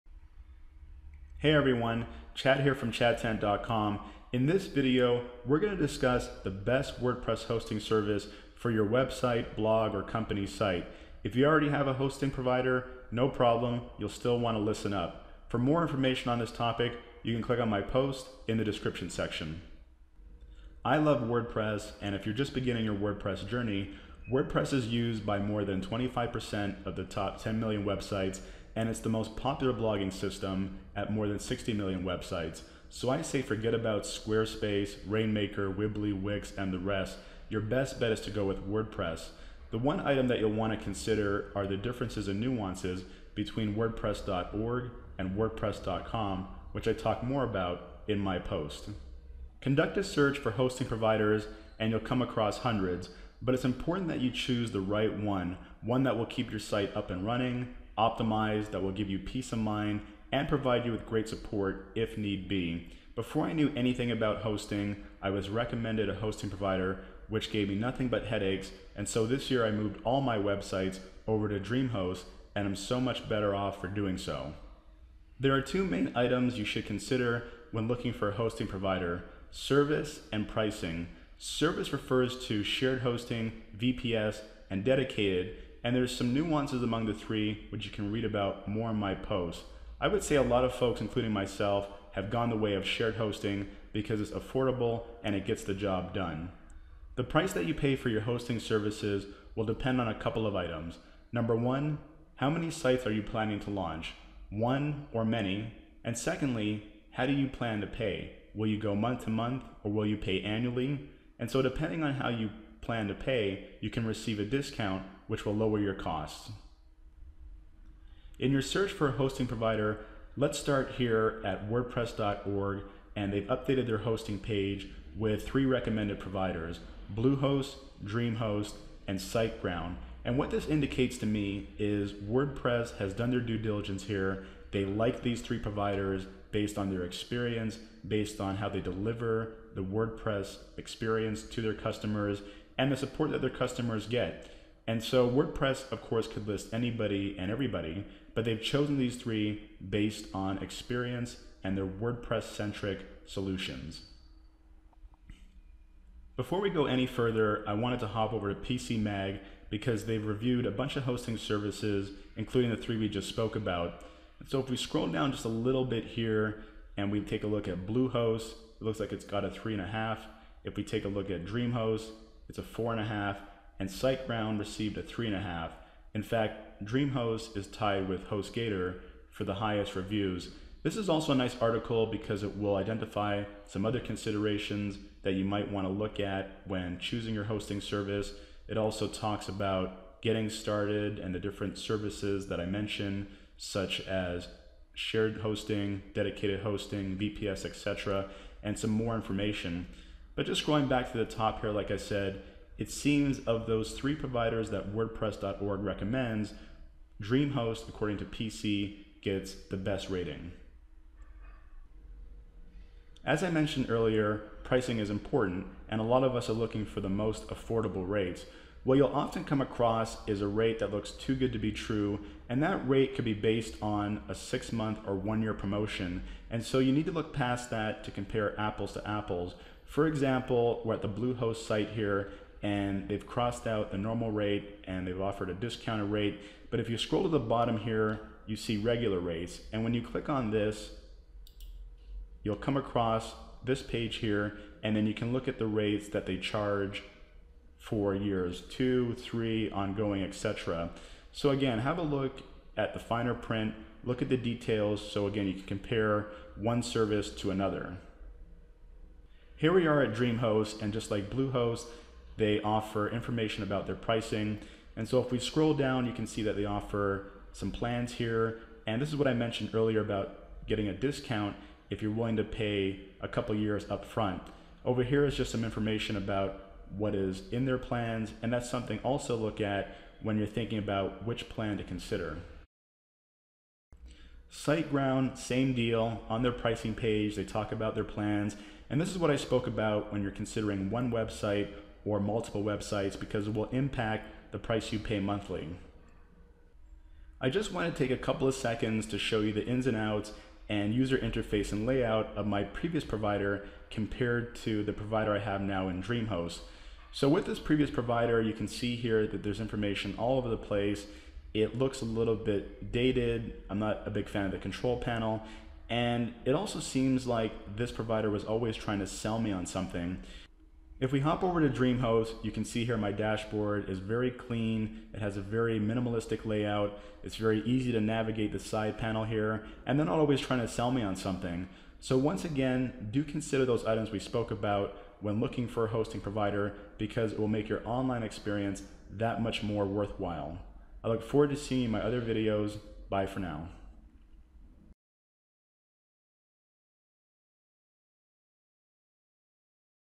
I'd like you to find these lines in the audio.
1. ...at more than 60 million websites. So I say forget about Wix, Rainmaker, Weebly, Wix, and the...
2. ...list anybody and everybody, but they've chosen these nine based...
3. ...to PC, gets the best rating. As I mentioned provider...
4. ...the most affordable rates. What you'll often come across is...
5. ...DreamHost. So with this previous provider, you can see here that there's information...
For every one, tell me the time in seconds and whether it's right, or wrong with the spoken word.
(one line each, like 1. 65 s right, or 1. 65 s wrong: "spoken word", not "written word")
1. 30 s wrong: "Squarespace", not "Wix"
2. 146 s wrong: "three", not "nine"
3. 208 s wrong: "earlier", not "provider"
4. 217 s right
5. 306 s right.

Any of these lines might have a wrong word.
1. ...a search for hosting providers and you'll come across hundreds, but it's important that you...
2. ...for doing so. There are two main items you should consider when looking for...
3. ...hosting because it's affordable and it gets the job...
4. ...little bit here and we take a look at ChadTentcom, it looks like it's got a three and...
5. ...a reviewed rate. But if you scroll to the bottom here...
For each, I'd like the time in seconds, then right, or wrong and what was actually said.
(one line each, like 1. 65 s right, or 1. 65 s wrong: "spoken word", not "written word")
1. 49 s right
2. 73 s right
3. 93 s right
4. 165 s wrong: "Bluehost", not "ChadTentcom"
5. 235 s wrong: "discounted", not "reviewed".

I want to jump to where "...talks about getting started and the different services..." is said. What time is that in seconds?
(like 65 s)
189 s.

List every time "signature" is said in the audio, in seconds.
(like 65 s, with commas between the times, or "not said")
not said.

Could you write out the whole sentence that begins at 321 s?
If we hop over to DreamHost, you can see here my dashboard is very clean.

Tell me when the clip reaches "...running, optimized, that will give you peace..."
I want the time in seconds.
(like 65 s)
57 s.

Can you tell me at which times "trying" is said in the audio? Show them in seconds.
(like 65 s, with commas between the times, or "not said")
318 s, 330 s.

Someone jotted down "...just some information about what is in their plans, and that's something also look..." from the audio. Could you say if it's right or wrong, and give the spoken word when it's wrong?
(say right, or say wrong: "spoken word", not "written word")
right.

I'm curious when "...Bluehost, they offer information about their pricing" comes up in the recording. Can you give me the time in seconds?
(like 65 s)
261 s.